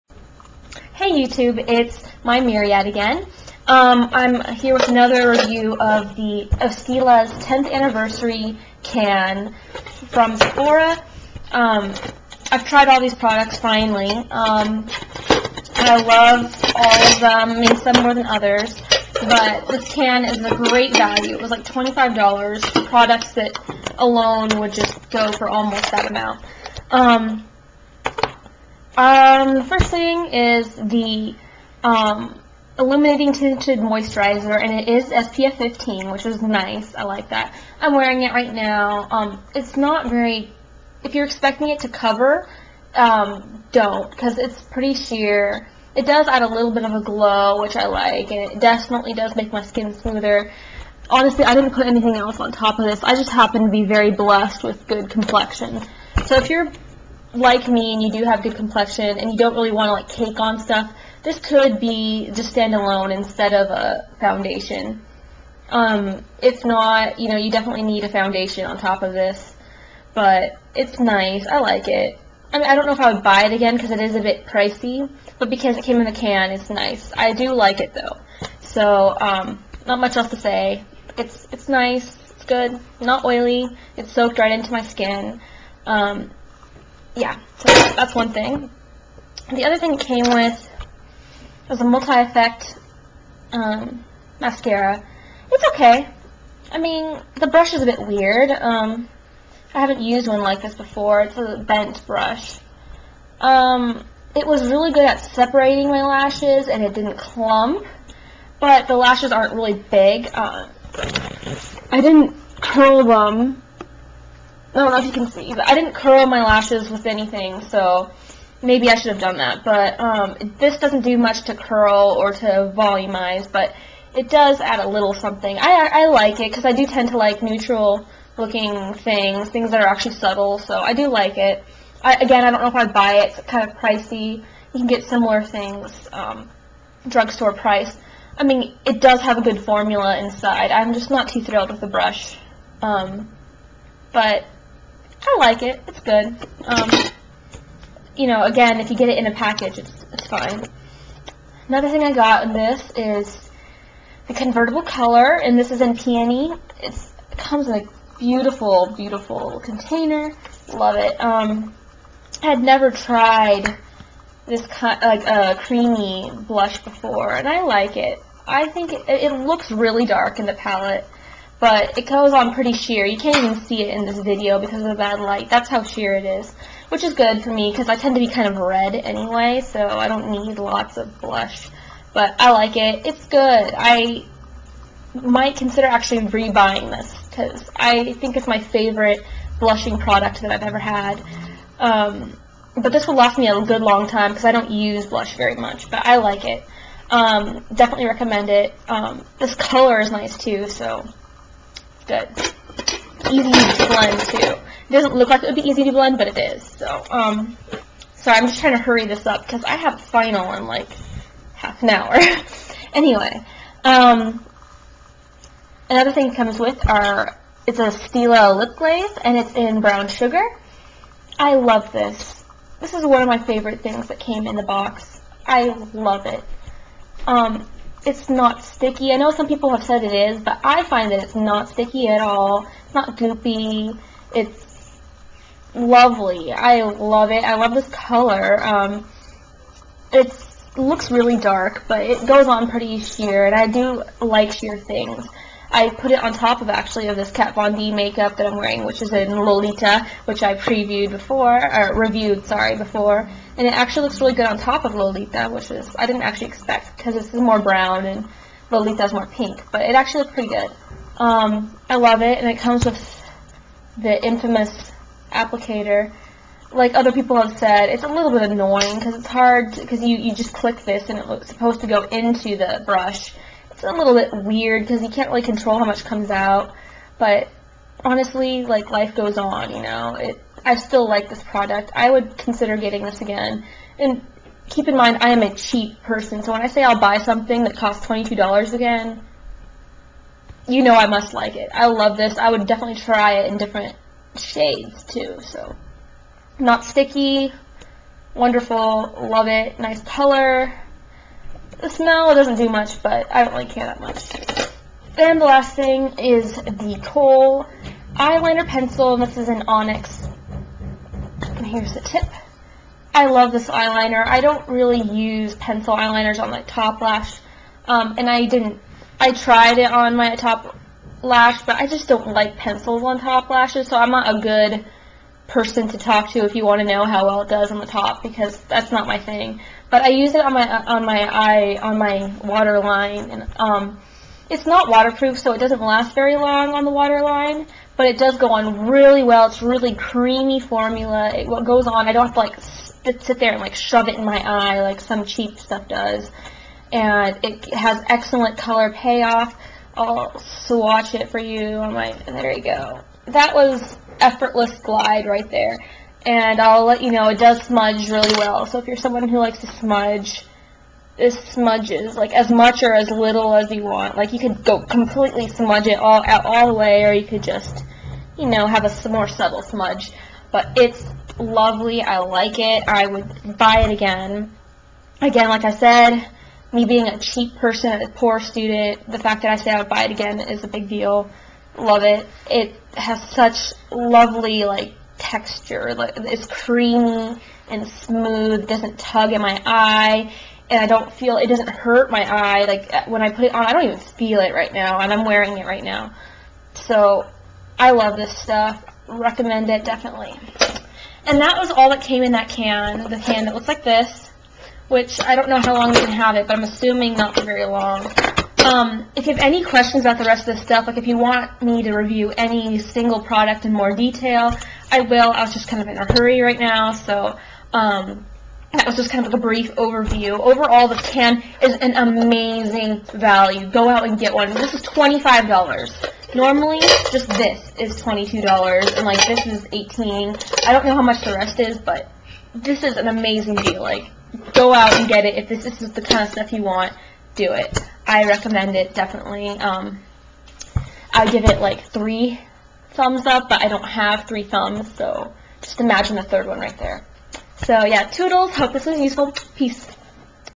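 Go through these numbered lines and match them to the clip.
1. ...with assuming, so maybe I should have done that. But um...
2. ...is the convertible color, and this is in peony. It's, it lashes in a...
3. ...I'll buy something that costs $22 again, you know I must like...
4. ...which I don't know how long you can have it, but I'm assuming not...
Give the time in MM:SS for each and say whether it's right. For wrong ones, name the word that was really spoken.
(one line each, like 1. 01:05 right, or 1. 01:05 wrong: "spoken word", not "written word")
1. 01:56 wrong: "anything", not "assuming"
2. 02:32 wrong: "comes", not "lashes"
3. 04:46 right
4. 06:44 right.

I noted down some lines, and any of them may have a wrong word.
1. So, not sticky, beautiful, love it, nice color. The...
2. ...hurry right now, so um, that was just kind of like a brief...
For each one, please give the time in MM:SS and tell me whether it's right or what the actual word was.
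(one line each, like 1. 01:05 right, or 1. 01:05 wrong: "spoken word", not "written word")
1. 04:55 wrong: "wonderful", not "beautiful"
2. 06:56 right.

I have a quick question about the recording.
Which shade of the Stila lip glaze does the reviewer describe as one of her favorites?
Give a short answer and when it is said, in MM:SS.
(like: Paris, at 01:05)
Brown sugar, at 03:39.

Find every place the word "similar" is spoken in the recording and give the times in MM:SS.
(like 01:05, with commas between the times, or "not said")
02:15.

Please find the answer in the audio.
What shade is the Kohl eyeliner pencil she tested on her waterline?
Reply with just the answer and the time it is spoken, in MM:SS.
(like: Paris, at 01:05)
Onyx, at 05:09.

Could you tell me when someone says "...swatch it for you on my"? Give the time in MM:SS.
05:50.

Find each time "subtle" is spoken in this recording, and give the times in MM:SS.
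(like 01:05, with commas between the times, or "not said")
02:10, 06:09.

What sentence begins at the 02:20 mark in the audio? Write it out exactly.
I'm just not too thrilled with the brush.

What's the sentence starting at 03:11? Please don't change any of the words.
Um, but this will last me a good long time because I don't use blush very much, but I like it.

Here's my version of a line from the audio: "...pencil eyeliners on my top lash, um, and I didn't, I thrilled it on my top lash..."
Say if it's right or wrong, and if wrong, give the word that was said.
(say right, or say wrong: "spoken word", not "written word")
wrong: "tried", not "thrilled".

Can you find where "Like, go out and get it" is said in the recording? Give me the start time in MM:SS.
07:13.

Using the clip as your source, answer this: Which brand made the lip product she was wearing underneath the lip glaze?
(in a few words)
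Kat Von D.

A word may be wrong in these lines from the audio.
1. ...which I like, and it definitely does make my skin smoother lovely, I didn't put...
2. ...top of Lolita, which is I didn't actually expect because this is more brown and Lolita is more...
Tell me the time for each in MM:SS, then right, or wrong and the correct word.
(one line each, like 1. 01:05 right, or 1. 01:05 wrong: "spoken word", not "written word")
1. 00:47 wrong: "honestly", not "lovely"
2. 04:14 right.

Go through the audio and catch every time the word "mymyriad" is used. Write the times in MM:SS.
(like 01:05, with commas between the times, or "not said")
00:02.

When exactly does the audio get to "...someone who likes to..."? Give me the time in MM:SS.
05:58.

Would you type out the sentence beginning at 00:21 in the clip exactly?
It was like $25 products that alone would just go for almost that amount.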